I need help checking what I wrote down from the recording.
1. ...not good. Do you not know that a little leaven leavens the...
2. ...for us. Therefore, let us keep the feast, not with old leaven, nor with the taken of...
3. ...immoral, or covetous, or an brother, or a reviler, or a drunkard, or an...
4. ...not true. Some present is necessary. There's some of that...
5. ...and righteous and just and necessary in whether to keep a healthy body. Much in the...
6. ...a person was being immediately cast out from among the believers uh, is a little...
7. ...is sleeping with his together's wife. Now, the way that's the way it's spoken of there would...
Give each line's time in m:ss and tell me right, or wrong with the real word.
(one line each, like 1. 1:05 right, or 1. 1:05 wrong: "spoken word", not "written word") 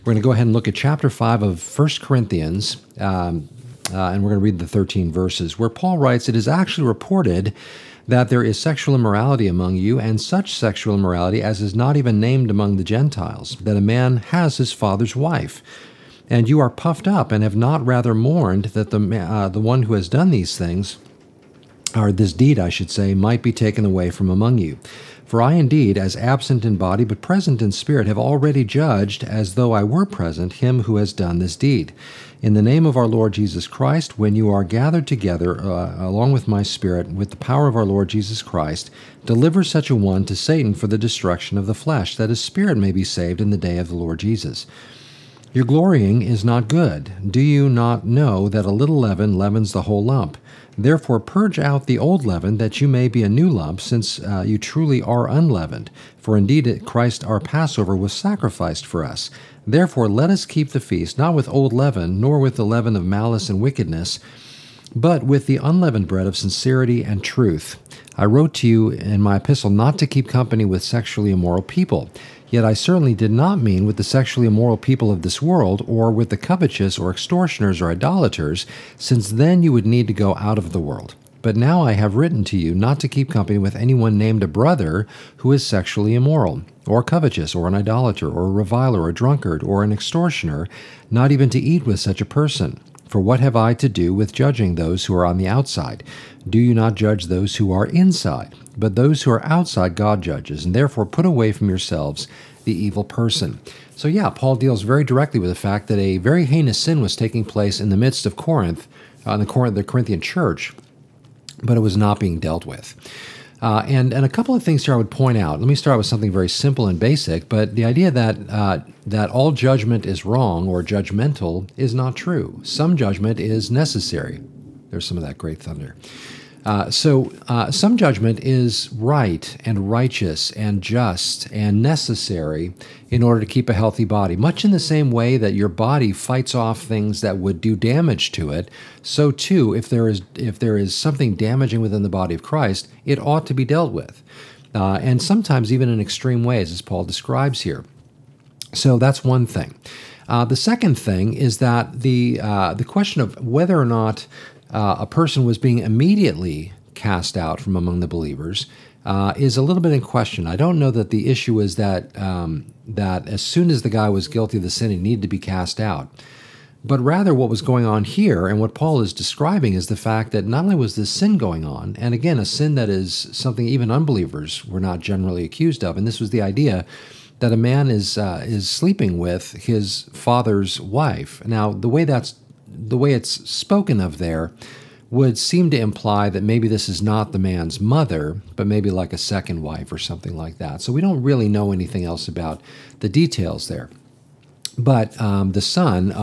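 1. 0:46 right
2. 0:58 wrong: "leaven", not "taken"
3. 1:26 wrong: "idolater", not "brother"
4. 2:01 wrong: "judgment", not "present"
5. 2:09 wrong: "order", not "whether"
6. 2:34 right
7. 2:58 wrong: "father", not "together".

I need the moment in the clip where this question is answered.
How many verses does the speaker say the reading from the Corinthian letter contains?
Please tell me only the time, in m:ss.
0:04.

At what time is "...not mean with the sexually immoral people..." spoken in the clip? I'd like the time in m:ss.
1:13.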